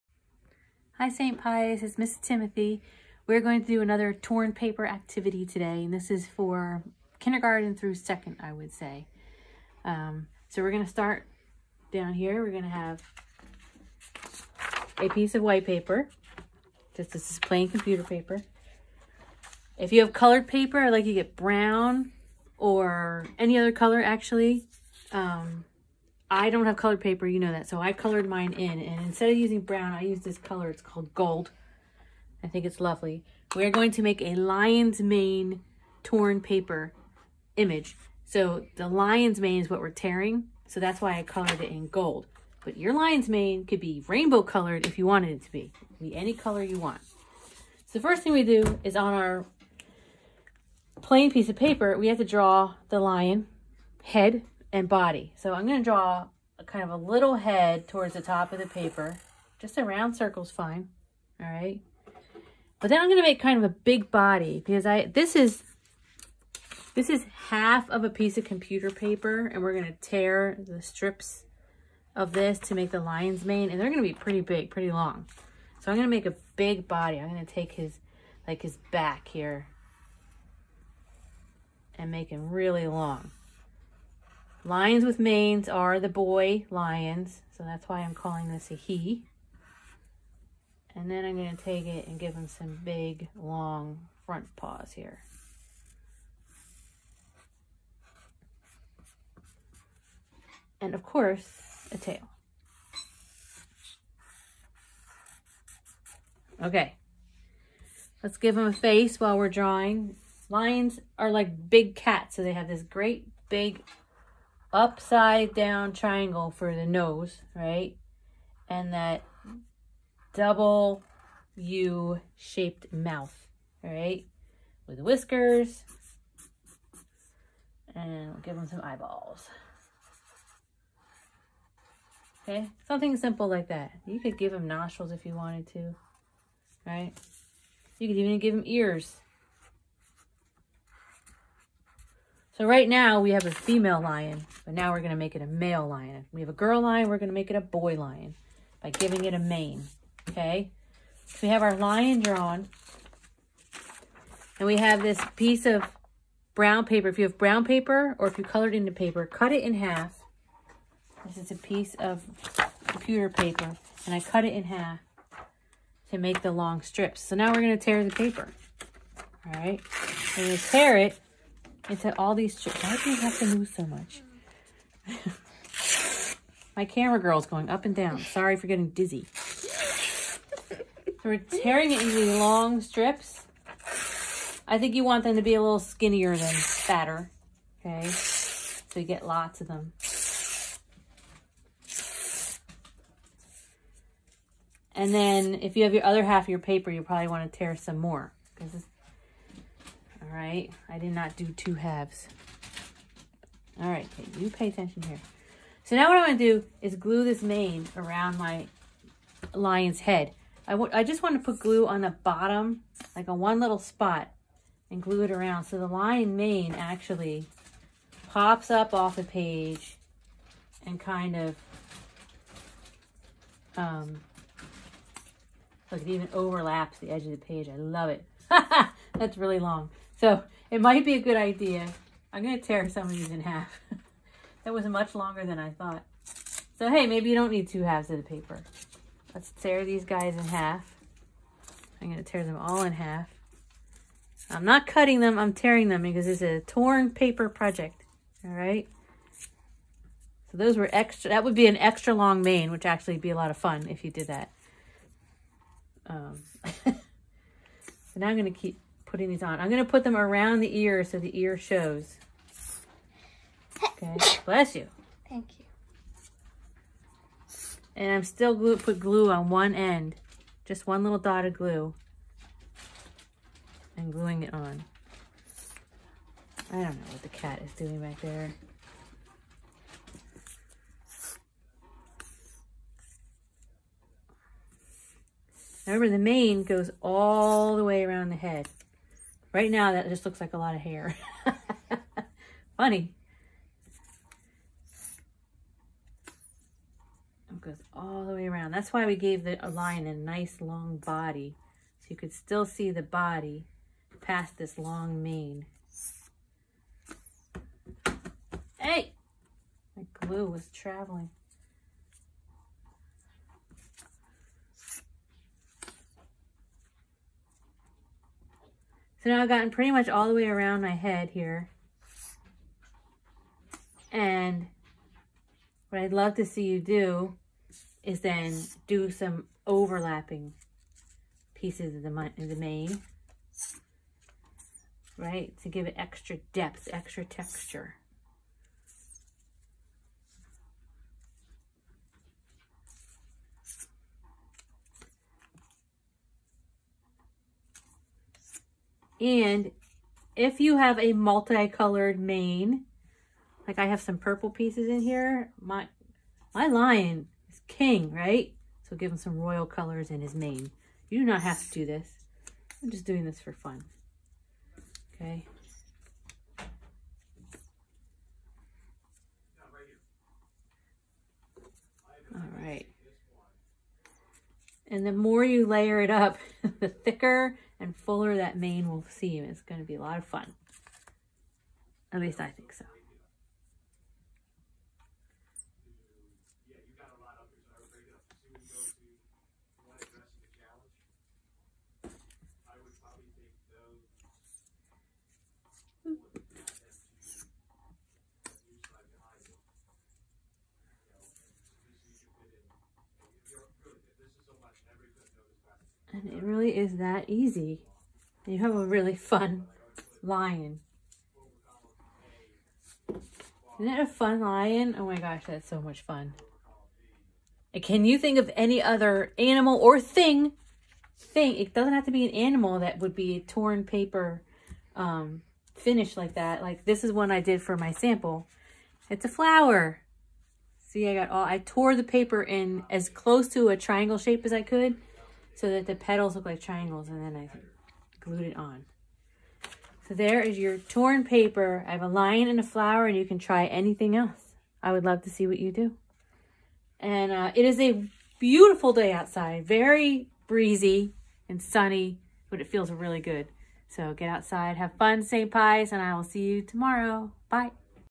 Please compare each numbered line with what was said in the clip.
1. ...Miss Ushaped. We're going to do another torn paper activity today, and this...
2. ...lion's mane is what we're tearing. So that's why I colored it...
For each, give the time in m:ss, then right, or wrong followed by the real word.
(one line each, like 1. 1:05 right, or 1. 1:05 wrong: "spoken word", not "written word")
1. 0:01 wrong: "Timothy", not "Ushaped"
2. 0:38 right.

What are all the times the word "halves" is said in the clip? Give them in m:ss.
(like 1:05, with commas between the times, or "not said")
3:21, 3:57.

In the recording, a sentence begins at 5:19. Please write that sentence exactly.
So now I've gotten pretty much all the way around my head here.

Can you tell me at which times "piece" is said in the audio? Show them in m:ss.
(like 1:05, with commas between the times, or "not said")
0:15, 0:51, 1:08, 2:35, 2:41, 5:31, 5:54.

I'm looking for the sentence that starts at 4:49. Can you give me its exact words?
Right now, that just looks like a lot of hair.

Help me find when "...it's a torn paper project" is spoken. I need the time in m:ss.
4:06.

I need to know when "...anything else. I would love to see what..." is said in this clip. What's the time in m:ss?
7:23.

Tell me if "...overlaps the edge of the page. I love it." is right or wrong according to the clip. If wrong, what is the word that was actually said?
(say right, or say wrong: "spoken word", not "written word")
right.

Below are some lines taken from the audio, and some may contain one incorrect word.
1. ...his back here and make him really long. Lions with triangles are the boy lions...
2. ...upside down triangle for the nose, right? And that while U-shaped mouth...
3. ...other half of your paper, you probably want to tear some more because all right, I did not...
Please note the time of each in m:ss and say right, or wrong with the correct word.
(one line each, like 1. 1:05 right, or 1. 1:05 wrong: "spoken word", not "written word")
1. 1:18 wrong: "manes", not "triangles"
2. 1:54 wrong: "double", not "while"
3. 3:16 right.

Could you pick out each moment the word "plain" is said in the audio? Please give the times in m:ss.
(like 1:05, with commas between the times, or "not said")
0:17, 0:51.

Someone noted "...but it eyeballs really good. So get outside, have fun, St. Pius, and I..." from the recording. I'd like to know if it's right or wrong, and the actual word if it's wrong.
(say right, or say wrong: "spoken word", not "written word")
wrong: "feels", not "eyeballs".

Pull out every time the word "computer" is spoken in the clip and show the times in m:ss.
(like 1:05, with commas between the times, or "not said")
0:17, 1:08, 2:42.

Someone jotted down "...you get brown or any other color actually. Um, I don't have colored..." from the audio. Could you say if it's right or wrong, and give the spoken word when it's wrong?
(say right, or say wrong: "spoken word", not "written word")
right.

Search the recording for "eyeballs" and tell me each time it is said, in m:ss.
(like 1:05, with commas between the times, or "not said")
2:08.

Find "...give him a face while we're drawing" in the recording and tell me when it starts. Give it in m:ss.
1:48.